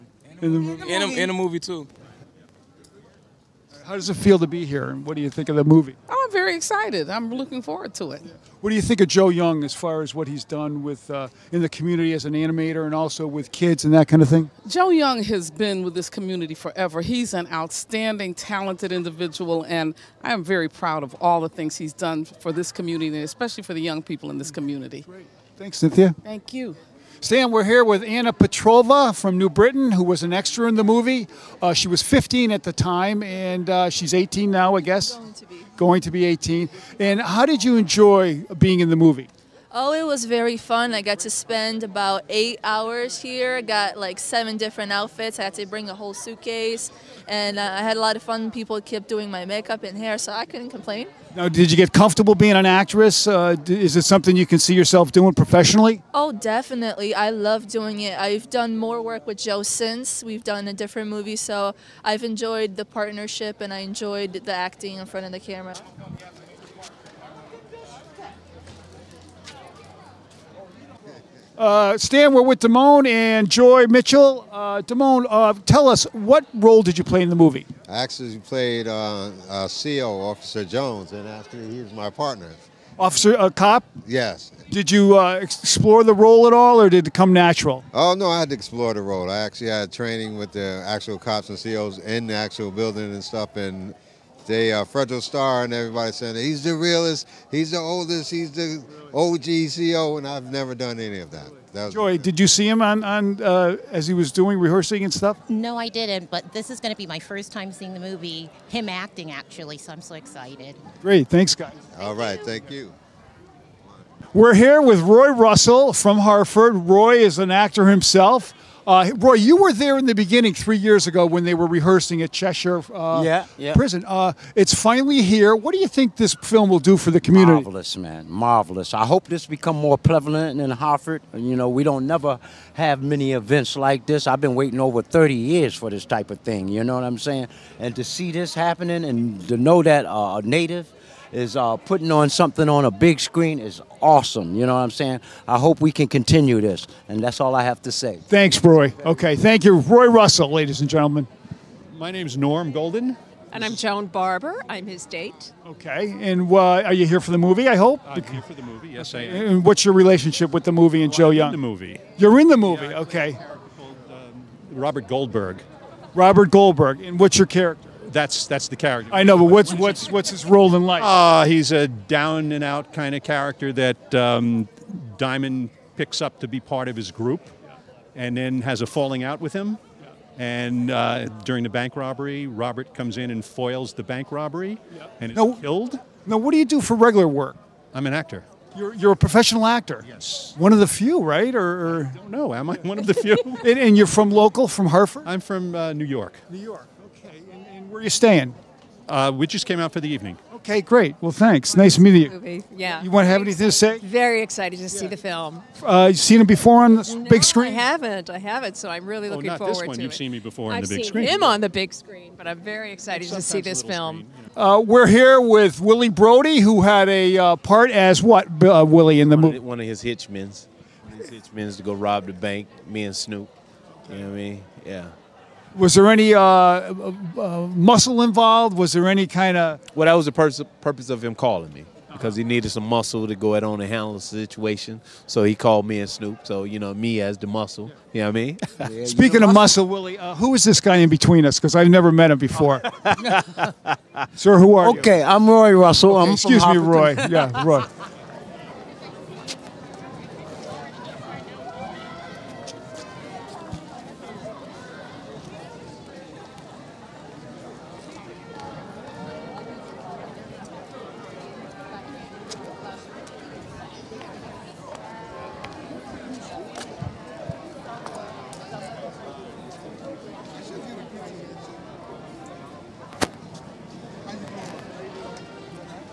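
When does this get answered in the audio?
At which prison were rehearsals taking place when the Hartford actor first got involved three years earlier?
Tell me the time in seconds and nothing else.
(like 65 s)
122 s.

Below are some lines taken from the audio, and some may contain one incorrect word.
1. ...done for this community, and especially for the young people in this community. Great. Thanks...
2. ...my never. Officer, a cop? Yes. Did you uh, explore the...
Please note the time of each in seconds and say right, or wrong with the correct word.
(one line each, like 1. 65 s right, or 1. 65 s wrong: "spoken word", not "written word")
1. 21 s right
2. 81 s wrong: "partner", not "never".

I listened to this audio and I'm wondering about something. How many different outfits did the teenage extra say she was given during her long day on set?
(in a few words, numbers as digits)
7.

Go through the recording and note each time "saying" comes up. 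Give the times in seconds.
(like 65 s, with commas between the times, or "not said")
96 s, 137 s, 144 s.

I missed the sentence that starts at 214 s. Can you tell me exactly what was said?
Uh, we're here with Willie Brody, who had a uh, part as what, uh, Willie, in the movie?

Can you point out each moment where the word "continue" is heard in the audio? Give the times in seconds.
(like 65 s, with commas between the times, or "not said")
146 s.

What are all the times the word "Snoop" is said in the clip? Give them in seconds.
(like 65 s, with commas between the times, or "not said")
223 s, 236 s.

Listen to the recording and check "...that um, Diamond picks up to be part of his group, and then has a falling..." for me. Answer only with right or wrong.
right.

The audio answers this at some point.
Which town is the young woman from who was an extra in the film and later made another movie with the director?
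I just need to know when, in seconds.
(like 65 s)
29 s.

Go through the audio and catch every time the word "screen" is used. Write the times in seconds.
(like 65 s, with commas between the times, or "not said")
143 s, 207 s, 211 s.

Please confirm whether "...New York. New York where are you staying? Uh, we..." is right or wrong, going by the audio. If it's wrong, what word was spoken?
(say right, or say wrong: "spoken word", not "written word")
right.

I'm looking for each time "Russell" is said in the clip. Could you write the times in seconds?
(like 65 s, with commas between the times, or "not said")
115 s, 150 s, 245 s.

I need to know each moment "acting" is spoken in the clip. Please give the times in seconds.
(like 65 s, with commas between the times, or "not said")
64 s, 108 s.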